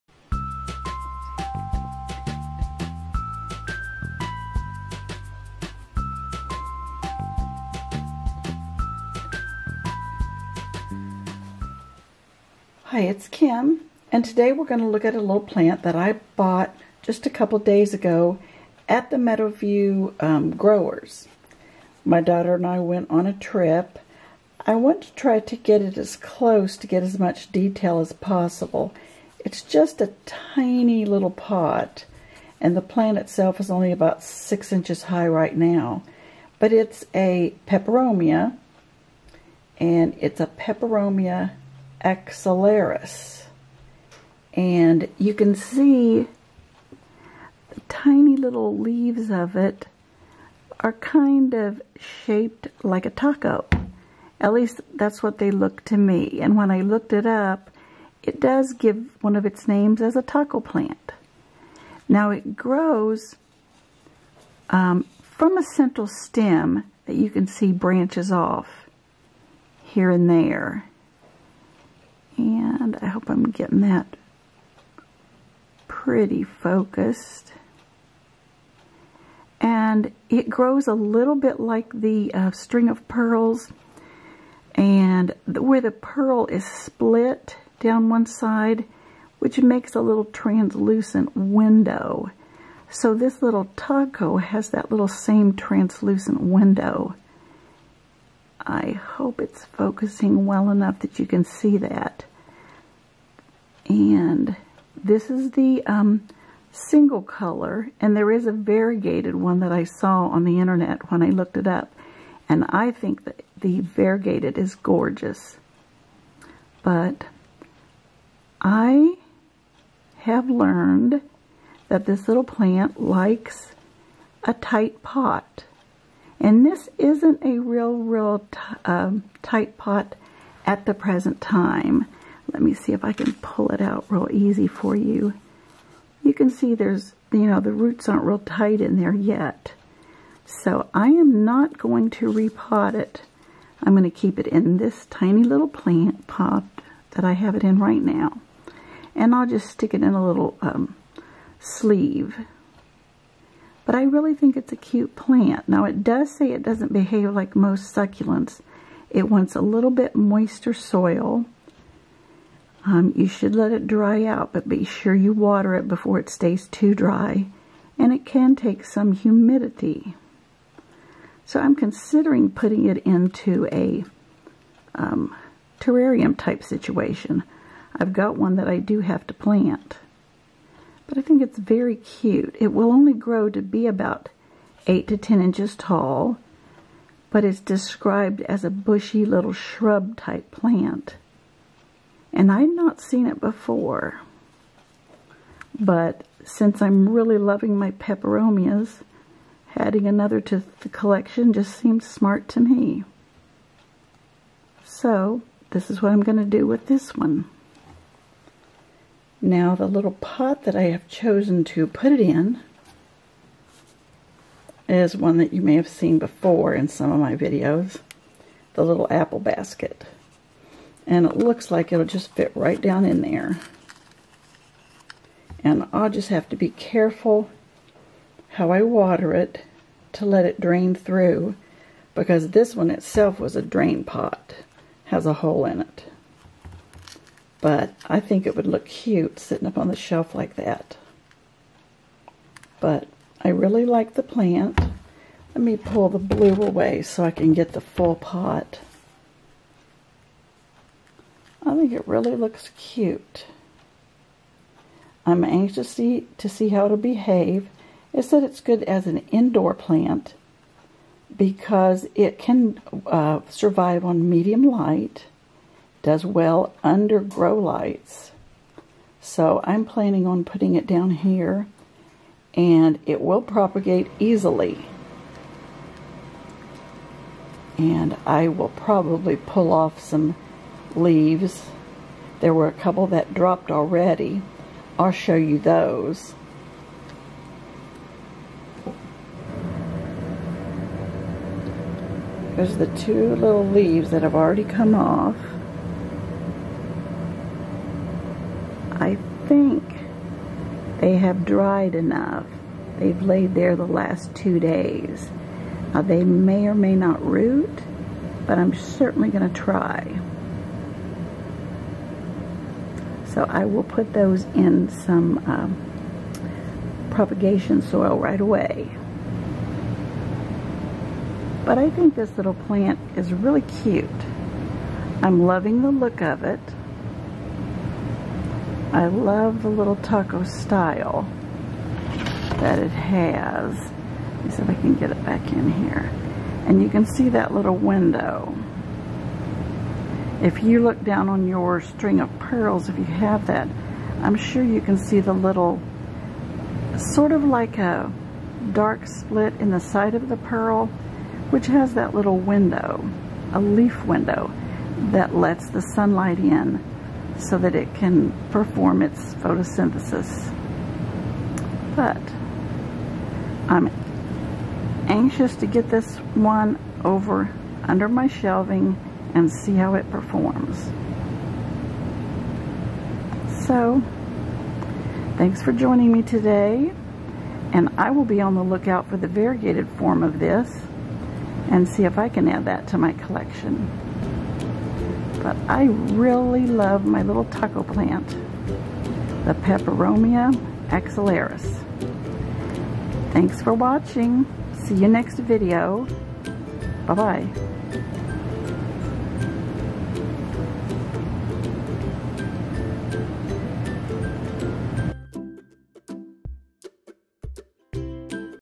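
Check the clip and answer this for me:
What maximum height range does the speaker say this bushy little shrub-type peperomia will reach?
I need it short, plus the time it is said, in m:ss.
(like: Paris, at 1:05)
8 to 10 inches, at 3:04.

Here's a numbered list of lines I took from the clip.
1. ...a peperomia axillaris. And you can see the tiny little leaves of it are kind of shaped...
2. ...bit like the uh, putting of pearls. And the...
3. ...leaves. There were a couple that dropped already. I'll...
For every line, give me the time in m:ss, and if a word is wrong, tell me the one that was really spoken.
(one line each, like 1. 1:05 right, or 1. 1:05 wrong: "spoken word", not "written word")
1. 0:40 right
2. 1:21 wrong: "string", not "putting"
3. 4:40 right.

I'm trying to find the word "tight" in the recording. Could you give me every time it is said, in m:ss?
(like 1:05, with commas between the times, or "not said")
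2:04, 2:09, 2:18.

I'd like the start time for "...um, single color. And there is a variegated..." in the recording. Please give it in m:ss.
1:45.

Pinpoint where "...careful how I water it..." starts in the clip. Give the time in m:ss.
3:46.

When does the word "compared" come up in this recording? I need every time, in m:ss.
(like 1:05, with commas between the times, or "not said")
not said.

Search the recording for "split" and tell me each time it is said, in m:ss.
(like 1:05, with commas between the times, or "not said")
1:26, 5:49.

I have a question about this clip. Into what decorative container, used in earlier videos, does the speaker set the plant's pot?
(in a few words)
apple basket.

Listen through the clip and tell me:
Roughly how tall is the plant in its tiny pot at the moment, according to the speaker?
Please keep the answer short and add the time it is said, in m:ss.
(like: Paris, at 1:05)
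6 inches, at 0:34.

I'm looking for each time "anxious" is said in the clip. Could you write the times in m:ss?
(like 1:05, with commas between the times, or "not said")
4:15, 6:05.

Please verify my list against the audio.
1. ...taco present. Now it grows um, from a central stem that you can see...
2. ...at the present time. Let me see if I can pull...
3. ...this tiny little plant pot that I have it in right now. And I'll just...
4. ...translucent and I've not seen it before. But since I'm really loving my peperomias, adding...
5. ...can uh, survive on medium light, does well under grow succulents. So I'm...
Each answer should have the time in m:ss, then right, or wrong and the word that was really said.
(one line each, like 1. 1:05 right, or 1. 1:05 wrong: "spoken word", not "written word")
1. 1:00 wrong: "plant", not "present"
2. 2:10 right
3. 2:24 right
4. 3:10 wrong: "plant", not "translucent"
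5. 4:22 wrong: "lights", not "succulents".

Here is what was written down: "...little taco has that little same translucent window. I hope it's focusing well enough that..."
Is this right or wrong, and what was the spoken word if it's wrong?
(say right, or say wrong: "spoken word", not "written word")
right.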